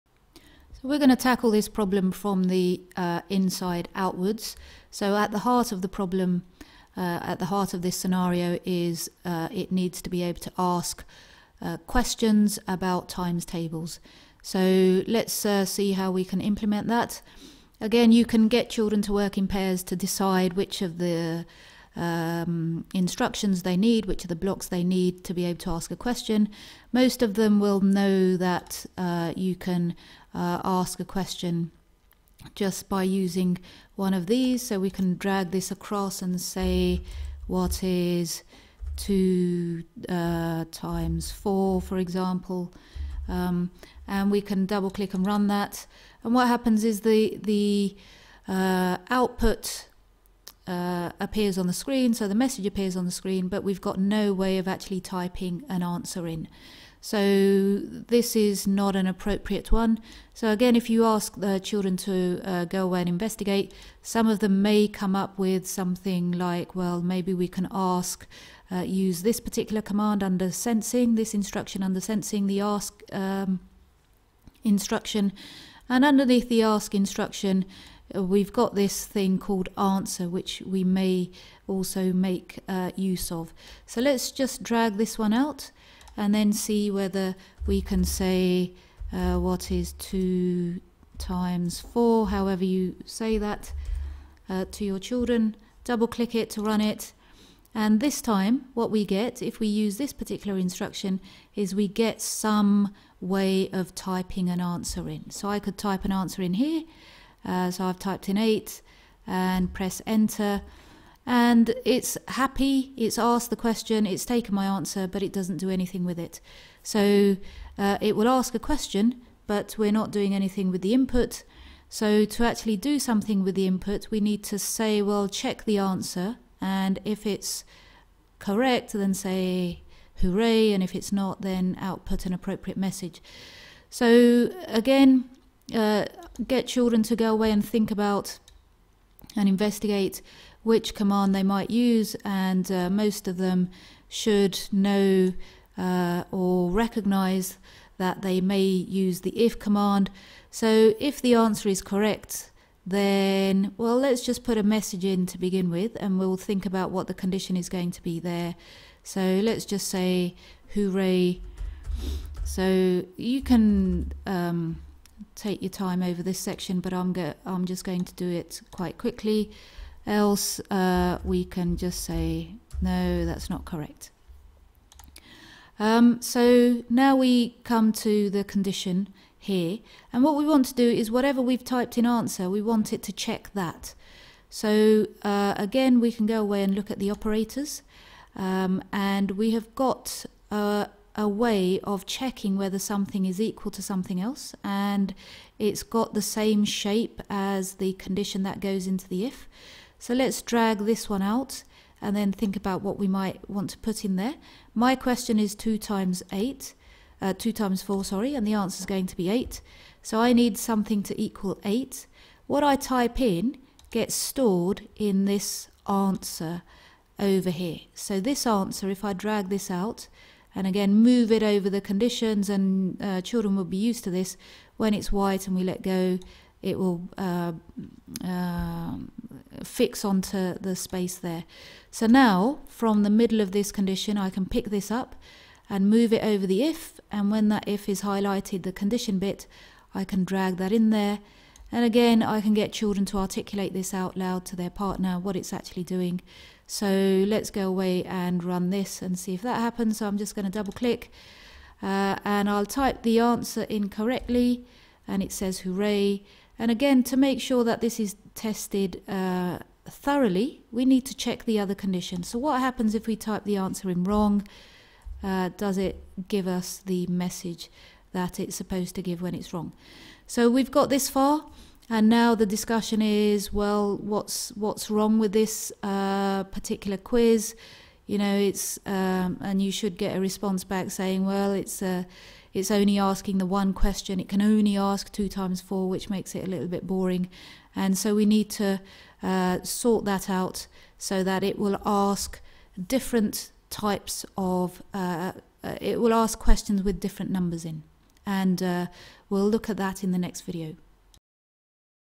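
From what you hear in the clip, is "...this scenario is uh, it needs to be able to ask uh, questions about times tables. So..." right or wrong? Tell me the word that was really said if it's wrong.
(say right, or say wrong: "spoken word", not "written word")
right.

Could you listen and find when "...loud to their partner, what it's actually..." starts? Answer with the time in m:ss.
4:04.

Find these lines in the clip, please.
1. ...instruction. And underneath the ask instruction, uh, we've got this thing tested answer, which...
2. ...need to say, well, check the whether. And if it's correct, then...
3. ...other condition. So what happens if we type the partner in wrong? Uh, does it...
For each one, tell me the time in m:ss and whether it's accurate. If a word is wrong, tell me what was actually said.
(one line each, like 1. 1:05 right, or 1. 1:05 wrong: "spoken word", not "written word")
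1. 1:14 wrong: "called", not "tested"
2. 2:04 wrong: "answer", not "whether"
3. 4:21 wrong: "answer", not "partner".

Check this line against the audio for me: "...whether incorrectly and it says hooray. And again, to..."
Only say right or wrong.
wrong.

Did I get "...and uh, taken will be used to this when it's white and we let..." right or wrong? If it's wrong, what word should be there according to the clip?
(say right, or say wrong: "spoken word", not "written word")
wrong: "children", not "taken".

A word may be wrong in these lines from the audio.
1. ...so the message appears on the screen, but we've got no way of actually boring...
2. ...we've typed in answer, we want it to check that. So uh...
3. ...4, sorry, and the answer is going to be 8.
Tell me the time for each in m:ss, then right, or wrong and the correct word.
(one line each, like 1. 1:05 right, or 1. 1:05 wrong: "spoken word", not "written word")
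1. 0:52 wrong: "typing", not "boring"
2. 3:01 right
3. 3:27 right.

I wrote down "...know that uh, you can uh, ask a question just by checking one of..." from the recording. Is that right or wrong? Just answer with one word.
wrong.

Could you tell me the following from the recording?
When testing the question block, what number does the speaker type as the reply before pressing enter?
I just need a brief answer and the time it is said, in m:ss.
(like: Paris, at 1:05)
8, at 1:48.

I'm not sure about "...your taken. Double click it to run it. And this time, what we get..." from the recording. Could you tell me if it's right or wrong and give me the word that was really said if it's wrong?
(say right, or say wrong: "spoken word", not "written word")
wrong: "children", not "taken".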